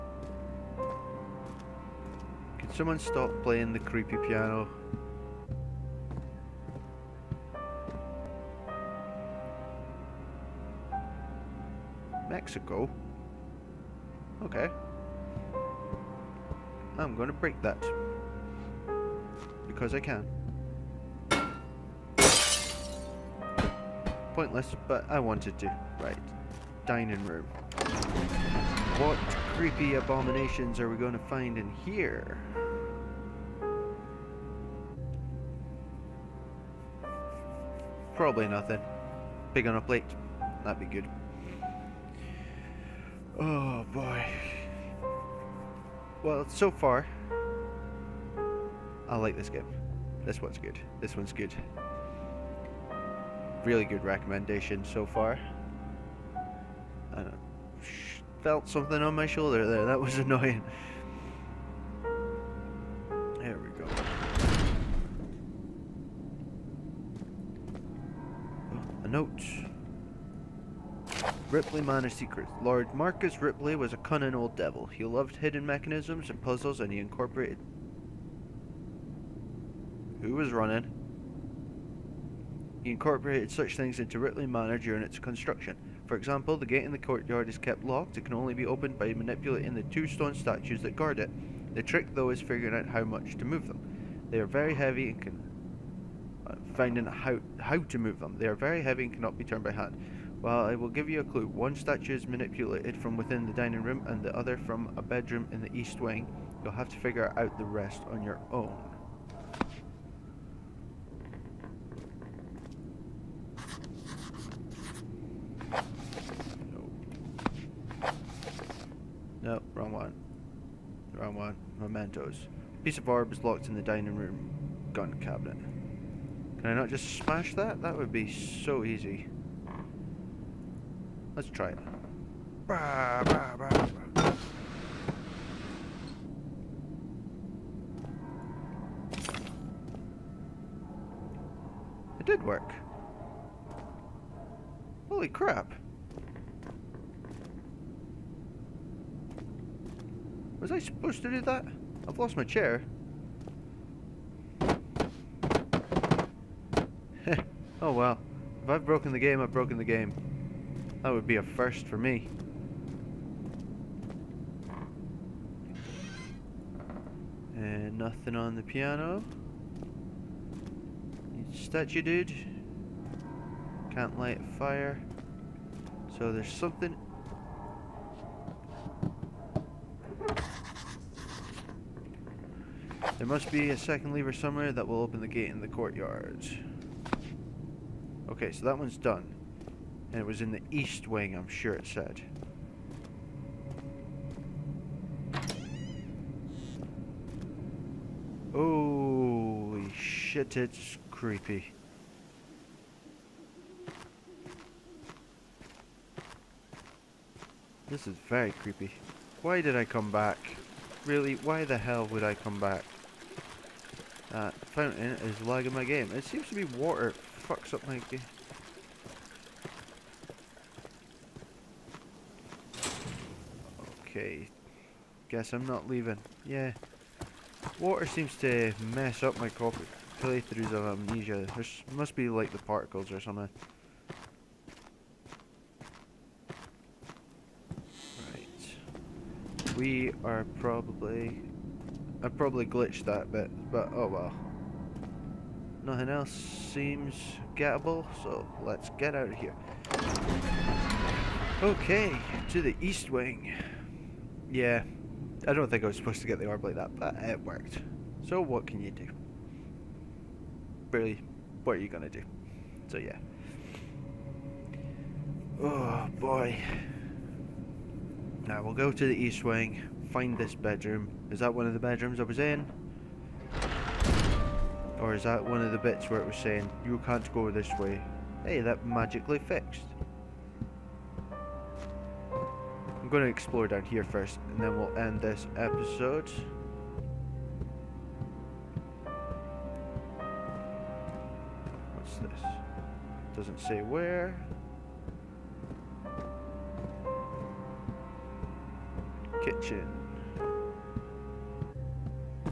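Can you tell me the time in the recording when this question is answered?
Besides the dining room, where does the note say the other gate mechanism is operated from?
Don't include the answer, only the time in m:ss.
1:44.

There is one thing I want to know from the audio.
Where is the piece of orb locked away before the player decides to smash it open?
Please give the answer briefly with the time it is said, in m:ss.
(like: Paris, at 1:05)
dining room gun cabinet, at 2:03.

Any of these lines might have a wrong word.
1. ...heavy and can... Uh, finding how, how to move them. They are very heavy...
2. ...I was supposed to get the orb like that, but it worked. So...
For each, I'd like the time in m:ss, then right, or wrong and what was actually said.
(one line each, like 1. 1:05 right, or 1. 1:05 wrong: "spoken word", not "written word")
1. 1:34 right
2. 4:15 right.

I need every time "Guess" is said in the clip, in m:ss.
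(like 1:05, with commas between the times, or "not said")
3:45.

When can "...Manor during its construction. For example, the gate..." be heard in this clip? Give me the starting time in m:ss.
1:24.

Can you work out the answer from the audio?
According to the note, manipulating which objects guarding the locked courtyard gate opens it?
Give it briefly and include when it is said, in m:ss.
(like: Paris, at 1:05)
two stone statues, at 1:29.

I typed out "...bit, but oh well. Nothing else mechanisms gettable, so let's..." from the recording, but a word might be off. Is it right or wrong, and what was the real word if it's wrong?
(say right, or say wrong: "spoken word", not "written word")
wrong: "seems", not "mechanisms".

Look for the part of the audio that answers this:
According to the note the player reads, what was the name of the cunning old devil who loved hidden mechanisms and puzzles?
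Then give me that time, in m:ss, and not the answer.
1:12.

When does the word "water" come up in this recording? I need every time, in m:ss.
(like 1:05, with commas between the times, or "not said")
3:36, 3:47.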